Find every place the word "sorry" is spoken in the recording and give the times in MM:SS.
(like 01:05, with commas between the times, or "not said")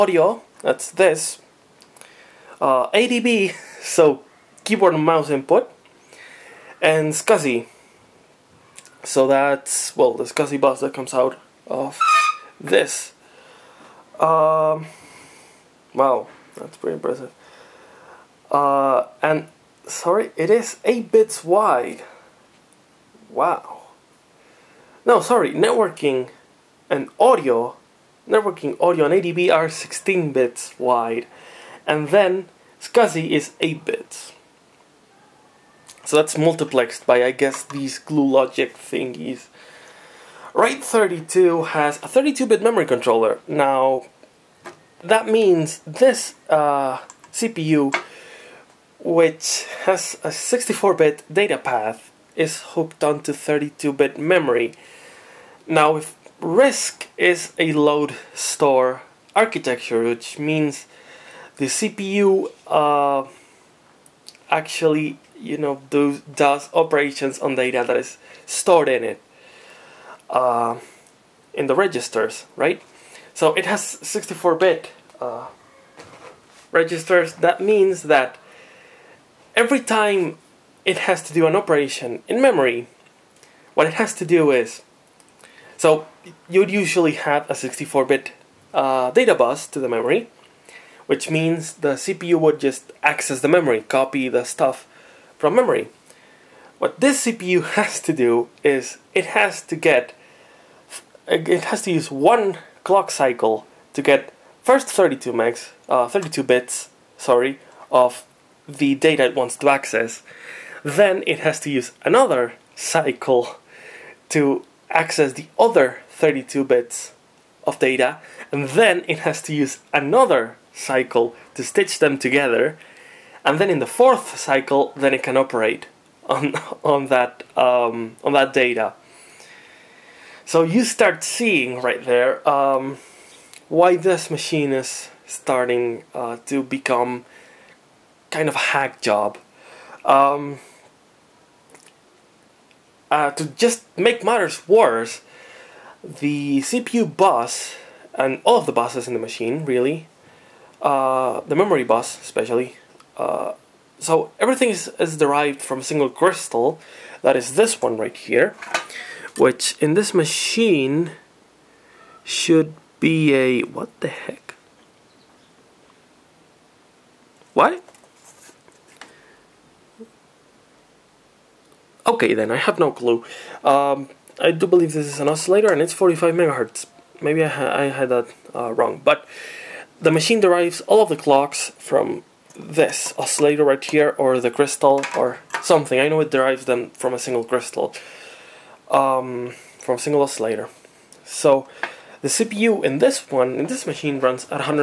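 00:19, 00:25, 01:47.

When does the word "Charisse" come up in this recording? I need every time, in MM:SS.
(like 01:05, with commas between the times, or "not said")
not said.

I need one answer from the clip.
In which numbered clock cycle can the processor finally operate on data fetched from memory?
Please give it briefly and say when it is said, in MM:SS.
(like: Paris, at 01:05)
Fourth, at 02:03.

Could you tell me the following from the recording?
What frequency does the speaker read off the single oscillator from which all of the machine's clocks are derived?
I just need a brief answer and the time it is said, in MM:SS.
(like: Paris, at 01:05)
45 MHz, at 02:55.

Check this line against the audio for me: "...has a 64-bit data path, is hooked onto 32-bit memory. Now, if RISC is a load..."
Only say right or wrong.
right.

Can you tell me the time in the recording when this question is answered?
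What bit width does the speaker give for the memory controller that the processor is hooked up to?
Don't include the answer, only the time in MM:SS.
00:42.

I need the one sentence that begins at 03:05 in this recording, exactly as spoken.
I know it derives them from a single crystal, um, from a single oscillator.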